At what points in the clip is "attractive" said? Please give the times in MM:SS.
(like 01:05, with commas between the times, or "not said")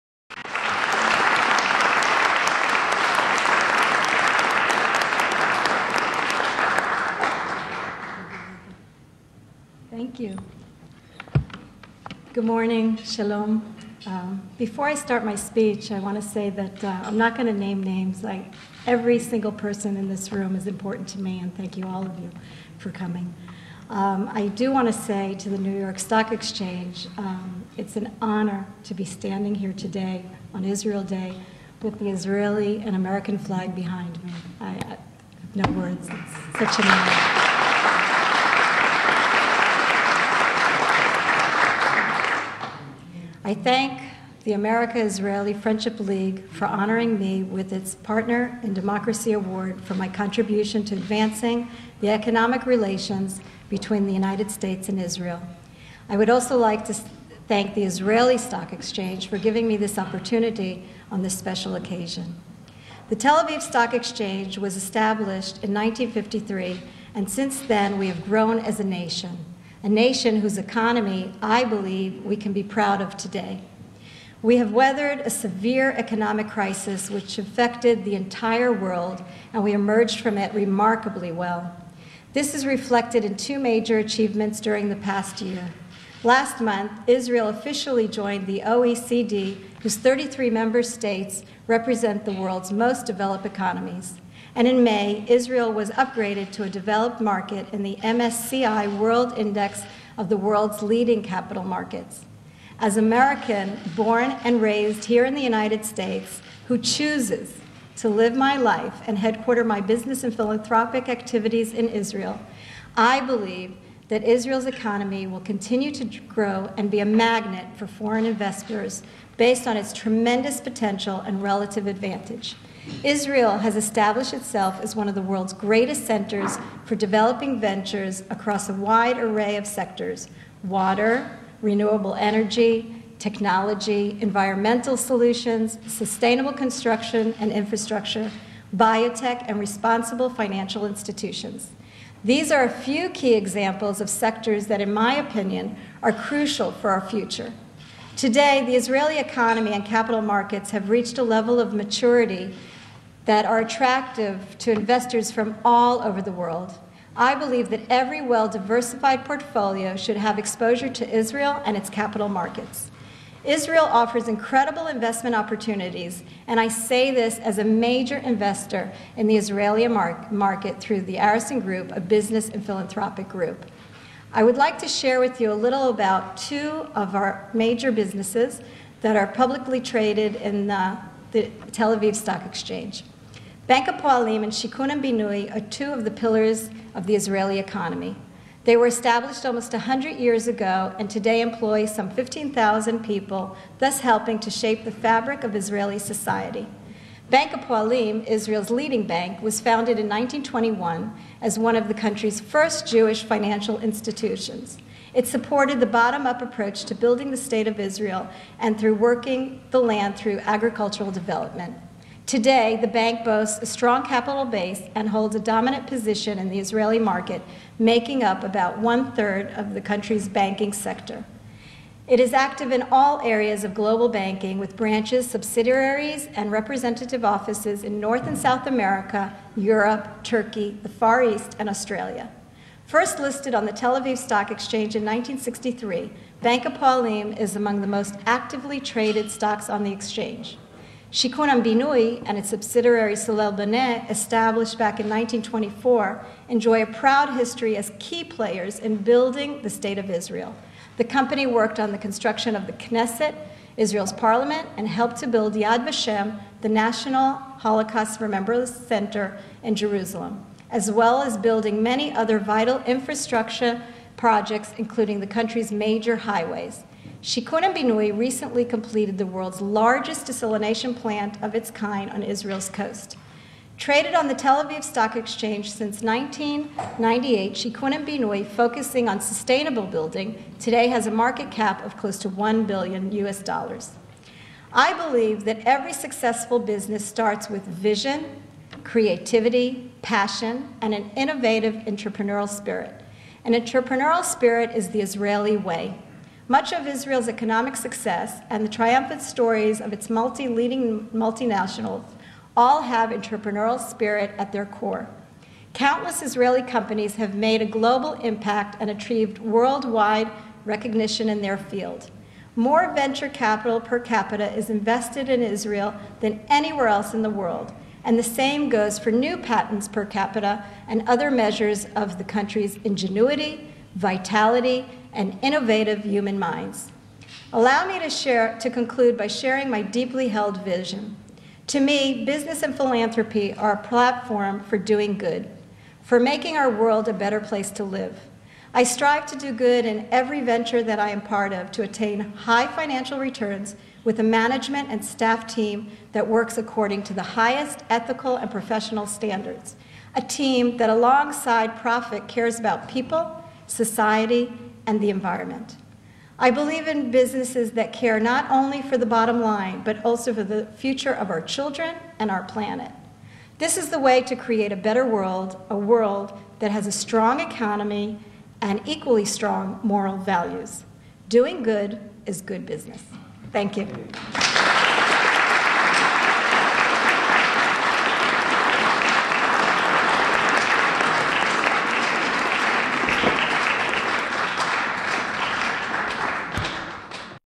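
02:33.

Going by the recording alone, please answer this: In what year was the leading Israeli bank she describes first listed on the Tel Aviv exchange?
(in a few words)
1963.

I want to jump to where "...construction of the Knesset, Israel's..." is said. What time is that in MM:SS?
04:11.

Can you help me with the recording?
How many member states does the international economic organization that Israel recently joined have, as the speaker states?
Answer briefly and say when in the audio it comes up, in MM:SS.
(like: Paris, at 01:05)
33, at 01:29.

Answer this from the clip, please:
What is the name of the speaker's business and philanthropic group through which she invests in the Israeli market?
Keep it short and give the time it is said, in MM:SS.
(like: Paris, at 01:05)
Arison Group, at 02:51.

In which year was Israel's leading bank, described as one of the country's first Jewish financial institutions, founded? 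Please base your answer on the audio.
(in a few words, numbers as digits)
1921.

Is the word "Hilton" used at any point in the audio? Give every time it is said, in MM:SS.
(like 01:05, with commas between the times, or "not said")
not said.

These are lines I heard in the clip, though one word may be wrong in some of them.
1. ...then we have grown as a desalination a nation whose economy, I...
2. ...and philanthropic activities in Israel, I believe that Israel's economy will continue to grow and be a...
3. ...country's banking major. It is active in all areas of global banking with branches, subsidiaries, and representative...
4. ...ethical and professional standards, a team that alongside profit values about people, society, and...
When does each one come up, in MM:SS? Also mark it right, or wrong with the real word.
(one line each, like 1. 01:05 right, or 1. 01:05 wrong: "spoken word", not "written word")
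1. 01:07 wrong: "nation", not "desalination"
2. 01:50 right
3. 03:39 wrong: "sector", not "major"
4. 05:47 wrong: "cares", not "values".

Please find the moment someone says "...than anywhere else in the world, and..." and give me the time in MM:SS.
05:16.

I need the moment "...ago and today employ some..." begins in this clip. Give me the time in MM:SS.
03:10.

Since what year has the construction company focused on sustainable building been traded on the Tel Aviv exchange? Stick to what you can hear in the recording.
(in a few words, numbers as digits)
1998.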